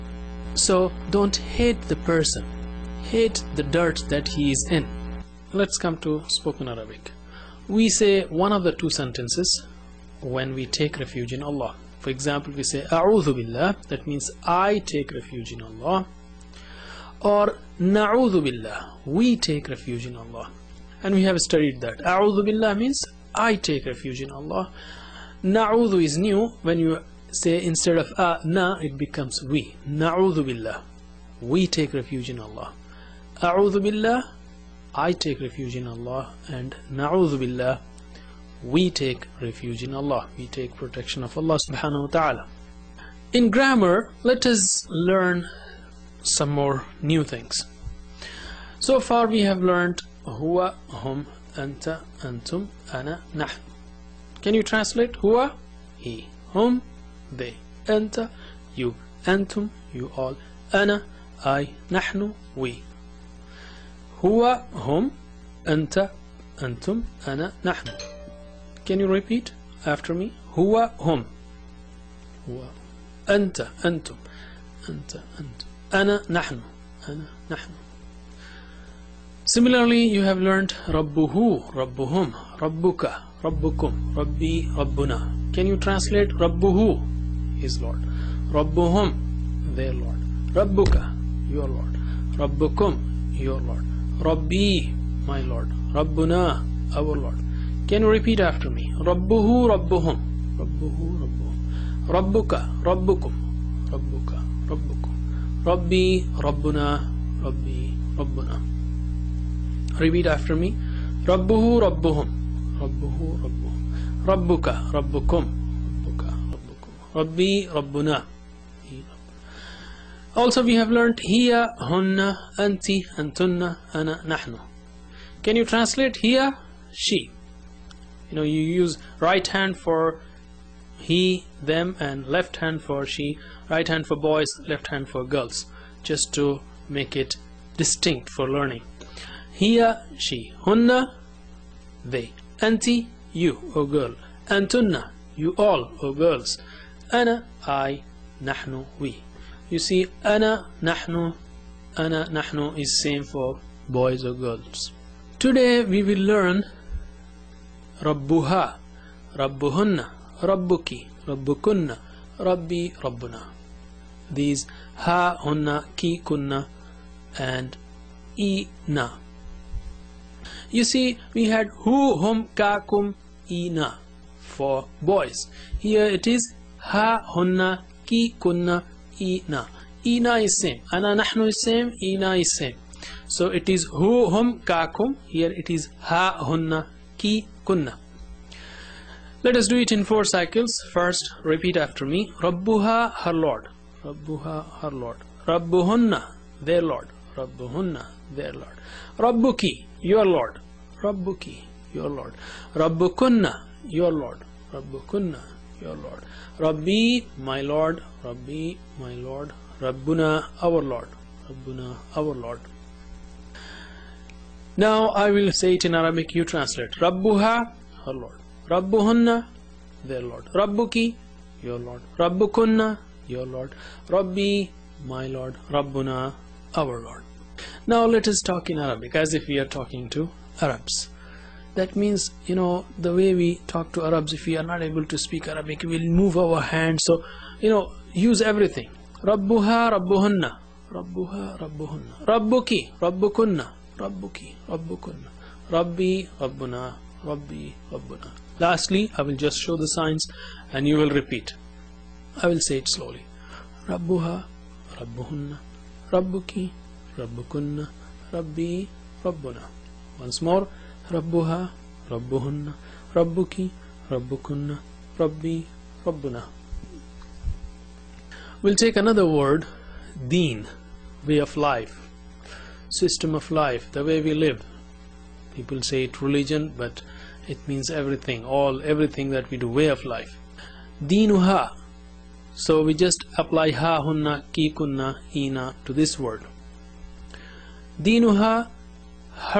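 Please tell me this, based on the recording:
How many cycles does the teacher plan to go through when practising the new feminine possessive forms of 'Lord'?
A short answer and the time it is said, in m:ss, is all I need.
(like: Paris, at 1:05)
4, at 3:10.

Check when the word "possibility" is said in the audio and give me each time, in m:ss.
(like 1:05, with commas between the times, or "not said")
not said.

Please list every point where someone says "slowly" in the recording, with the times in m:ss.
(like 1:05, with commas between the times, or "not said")
4:12.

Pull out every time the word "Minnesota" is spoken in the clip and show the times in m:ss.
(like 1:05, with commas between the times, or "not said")
not said.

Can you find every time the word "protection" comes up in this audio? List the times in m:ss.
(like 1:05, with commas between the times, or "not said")
0:40.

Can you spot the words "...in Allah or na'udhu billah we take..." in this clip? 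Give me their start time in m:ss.
0:15.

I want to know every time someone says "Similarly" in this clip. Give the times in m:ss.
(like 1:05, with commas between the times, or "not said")
1:19.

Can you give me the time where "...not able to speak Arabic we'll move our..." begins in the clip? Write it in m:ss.
3:54.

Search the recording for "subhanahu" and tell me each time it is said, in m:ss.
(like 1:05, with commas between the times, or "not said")
0:41.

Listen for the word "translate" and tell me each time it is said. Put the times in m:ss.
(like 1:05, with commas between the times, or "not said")
0:54, 1:25, 2:05, 3:36.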